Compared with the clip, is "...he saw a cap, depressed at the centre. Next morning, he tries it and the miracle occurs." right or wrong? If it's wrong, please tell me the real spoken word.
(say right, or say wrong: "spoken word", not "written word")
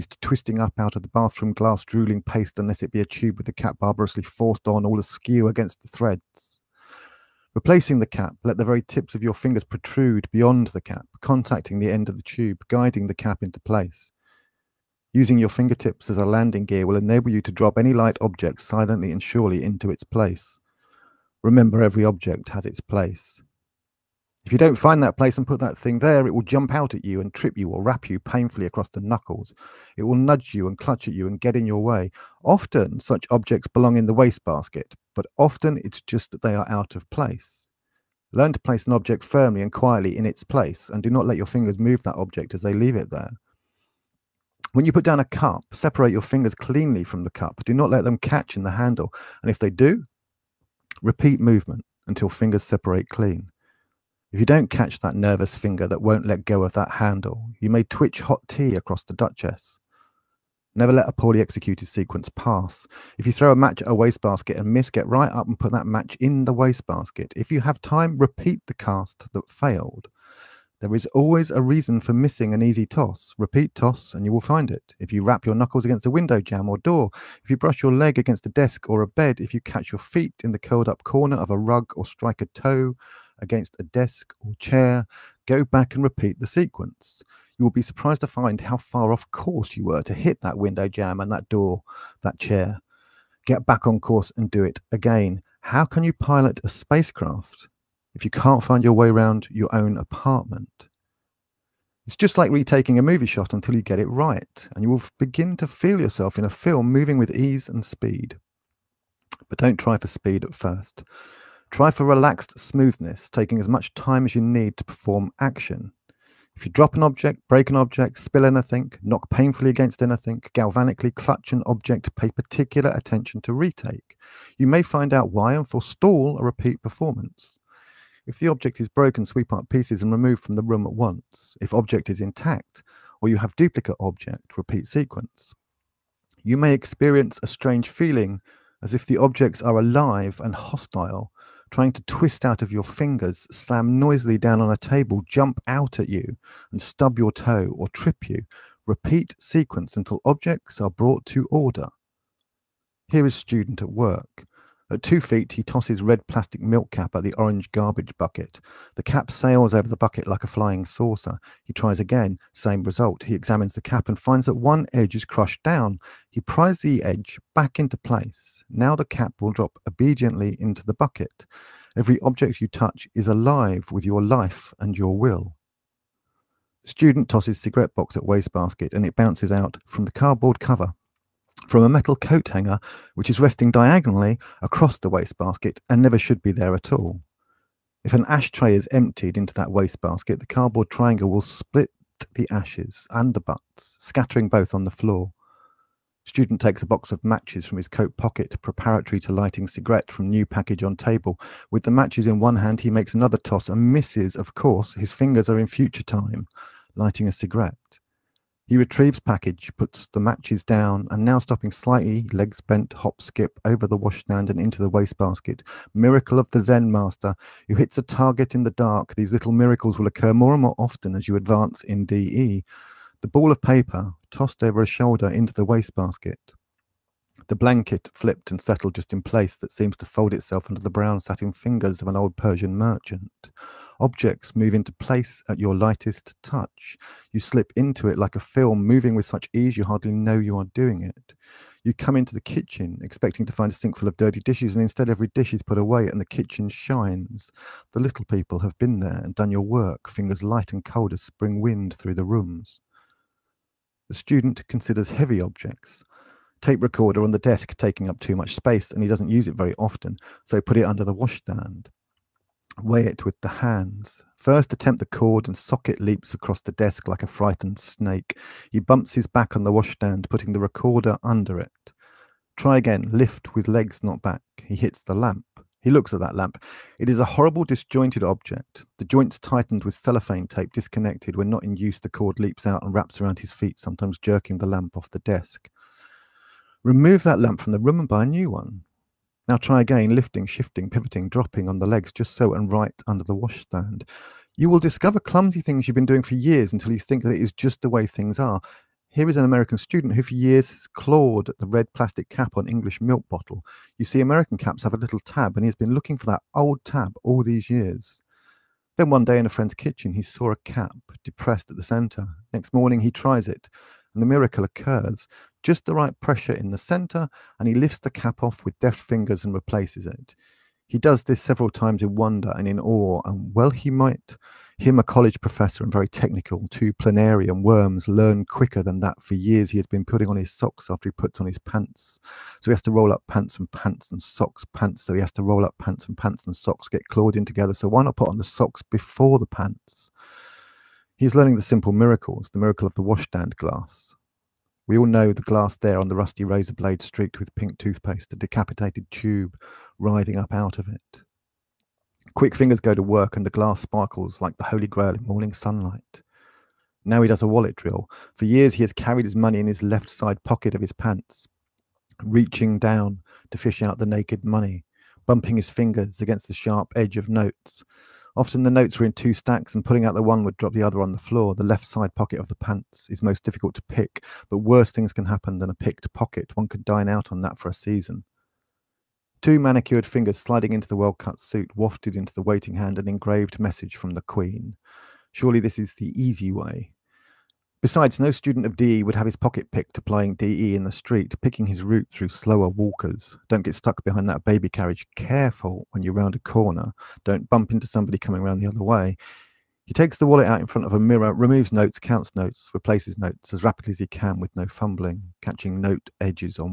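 right.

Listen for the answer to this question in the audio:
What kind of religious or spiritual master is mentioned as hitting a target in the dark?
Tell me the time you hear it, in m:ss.
3:36.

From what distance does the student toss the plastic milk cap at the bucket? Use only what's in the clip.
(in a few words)
2 feet.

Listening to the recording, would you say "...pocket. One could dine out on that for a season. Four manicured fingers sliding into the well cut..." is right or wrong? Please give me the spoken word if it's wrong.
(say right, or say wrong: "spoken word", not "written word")
wrong: "Two", not "Four".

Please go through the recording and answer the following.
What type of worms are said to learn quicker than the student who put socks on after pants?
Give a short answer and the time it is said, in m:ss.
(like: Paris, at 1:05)
planarian worms, at 5:26.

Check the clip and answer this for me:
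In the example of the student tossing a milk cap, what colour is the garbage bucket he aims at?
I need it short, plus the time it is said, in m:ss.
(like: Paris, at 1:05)
orange, at 2:37.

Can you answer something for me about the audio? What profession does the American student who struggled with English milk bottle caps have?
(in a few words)
college professor.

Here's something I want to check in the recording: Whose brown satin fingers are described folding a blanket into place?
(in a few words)
an old Persian merchant.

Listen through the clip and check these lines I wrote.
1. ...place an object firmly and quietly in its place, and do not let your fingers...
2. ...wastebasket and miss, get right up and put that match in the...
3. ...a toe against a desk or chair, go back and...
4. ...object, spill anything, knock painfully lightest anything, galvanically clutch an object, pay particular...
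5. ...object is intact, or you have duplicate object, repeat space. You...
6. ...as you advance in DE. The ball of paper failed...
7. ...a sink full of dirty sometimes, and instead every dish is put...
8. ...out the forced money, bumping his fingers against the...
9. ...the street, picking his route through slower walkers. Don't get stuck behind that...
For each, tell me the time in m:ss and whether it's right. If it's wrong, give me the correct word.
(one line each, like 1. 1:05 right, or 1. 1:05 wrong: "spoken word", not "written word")
1. 0:38 right
2. 1:03 right
3. 1:22 right
4. 1:57 wrong: "against", not "lightest"
5. 2:11 wrong: "sequence", not "space"
6. 3:41 wrong: "tossed", not "failed"
7. 4:03 wrong: "dishes", not "sometimes"
8. 6:03 wrong: "naked", not "forced"
9. 6:30 right.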